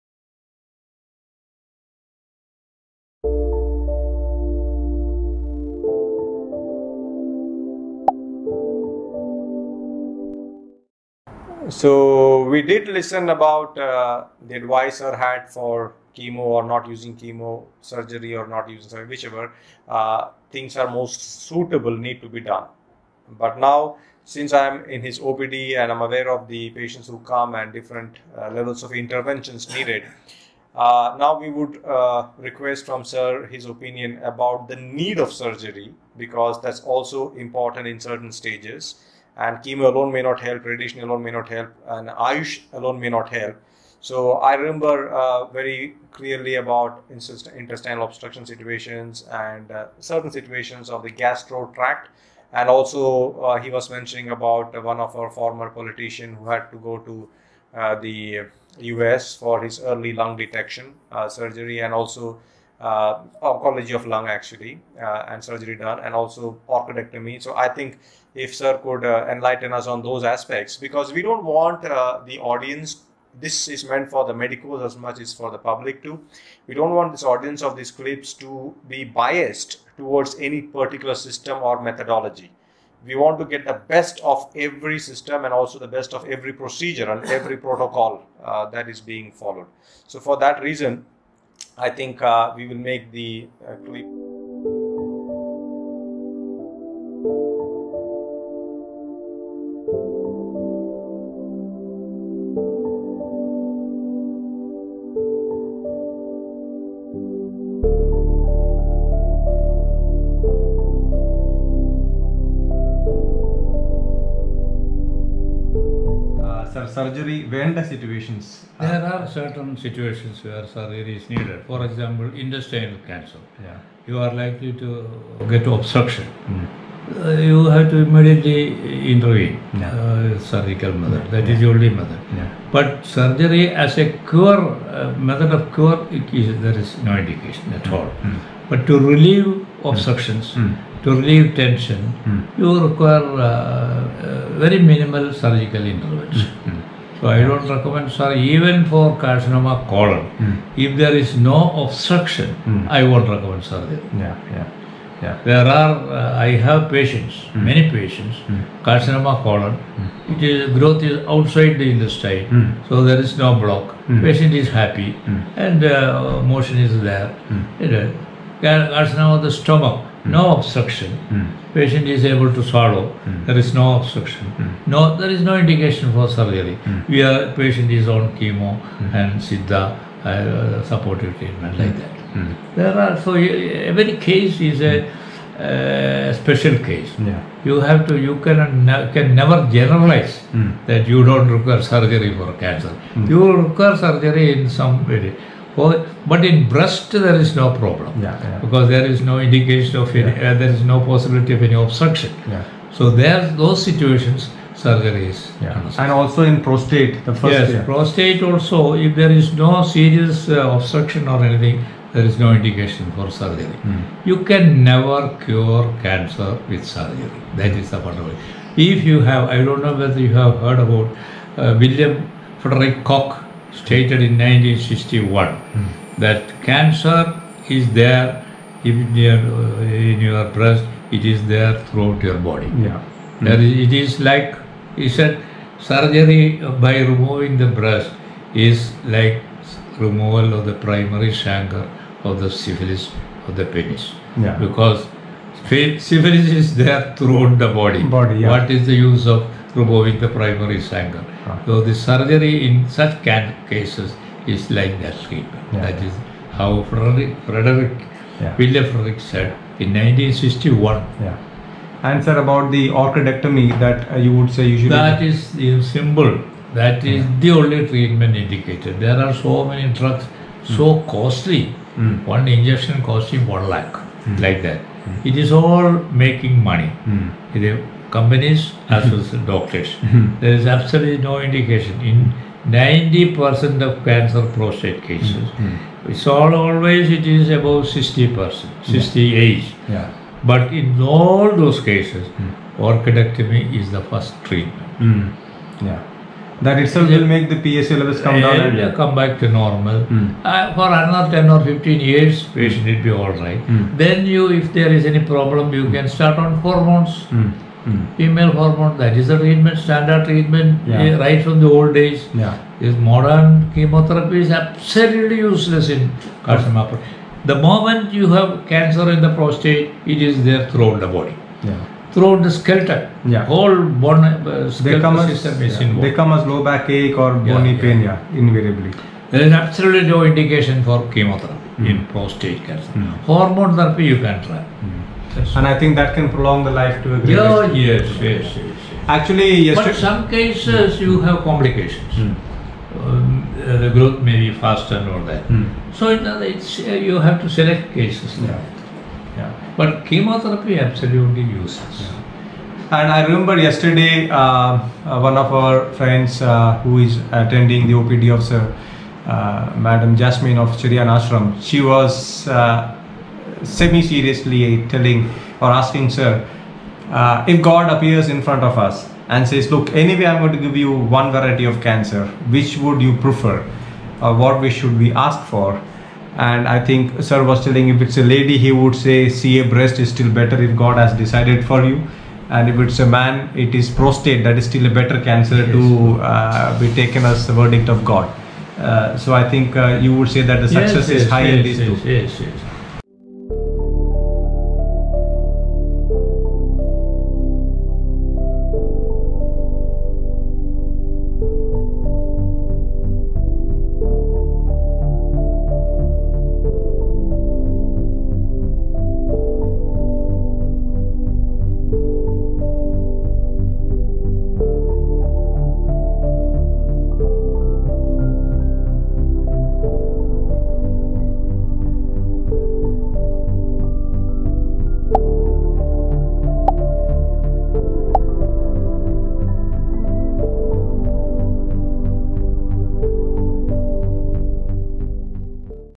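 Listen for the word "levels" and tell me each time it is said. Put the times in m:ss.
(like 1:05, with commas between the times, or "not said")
0:28, 4:57.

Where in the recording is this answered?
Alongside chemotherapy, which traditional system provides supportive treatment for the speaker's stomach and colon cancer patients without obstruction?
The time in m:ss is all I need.
2:59.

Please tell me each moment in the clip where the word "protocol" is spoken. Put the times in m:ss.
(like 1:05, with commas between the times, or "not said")
1:27.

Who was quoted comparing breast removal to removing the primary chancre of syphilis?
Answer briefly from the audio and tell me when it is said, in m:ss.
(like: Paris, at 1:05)
William Frederick Koch, at 3:41.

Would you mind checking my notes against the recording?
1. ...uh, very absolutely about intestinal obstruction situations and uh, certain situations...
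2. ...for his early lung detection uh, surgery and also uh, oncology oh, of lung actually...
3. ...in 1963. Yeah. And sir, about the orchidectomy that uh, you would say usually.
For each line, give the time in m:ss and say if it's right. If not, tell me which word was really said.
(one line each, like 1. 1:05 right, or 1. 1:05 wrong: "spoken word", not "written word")
1. 0:45 wrong: "clearly", not "absolutely"
2. 0:59 right
3. 4:19 wrong: "1961", not "1963".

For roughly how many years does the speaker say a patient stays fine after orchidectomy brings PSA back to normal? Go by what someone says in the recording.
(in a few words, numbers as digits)
10 or 15 years.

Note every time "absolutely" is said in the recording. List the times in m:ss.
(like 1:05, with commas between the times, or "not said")
4:40, 5:14, 5:29, 5:50.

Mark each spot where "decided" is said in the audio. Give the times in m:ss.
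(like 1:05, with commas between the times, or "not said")
6:21.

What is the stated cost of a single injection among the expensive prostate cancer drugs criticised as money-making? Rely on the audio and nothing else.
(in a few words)
1 lakh.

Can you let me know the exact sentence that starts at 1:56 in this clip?
surgery When the situations There are certain situations where surgery is needed.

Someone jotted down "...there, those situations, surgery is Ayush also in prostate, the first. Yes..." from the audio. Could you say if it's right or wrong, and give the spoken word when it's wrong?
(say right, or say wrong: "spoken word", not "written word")
wrong: "And", not "Ayush".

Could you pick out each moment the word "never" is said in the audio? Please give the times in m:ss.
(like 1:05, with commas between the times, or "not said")
3:09, 3:34.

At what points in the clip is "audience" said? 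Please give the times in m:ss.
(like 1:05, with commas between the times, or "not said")
1:12, 1:17.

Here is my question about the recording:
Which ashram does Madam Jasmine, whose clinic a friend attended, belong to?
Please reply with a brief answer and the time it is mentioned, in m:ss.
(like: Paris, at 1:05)
Chirian Ashram, at 6:00.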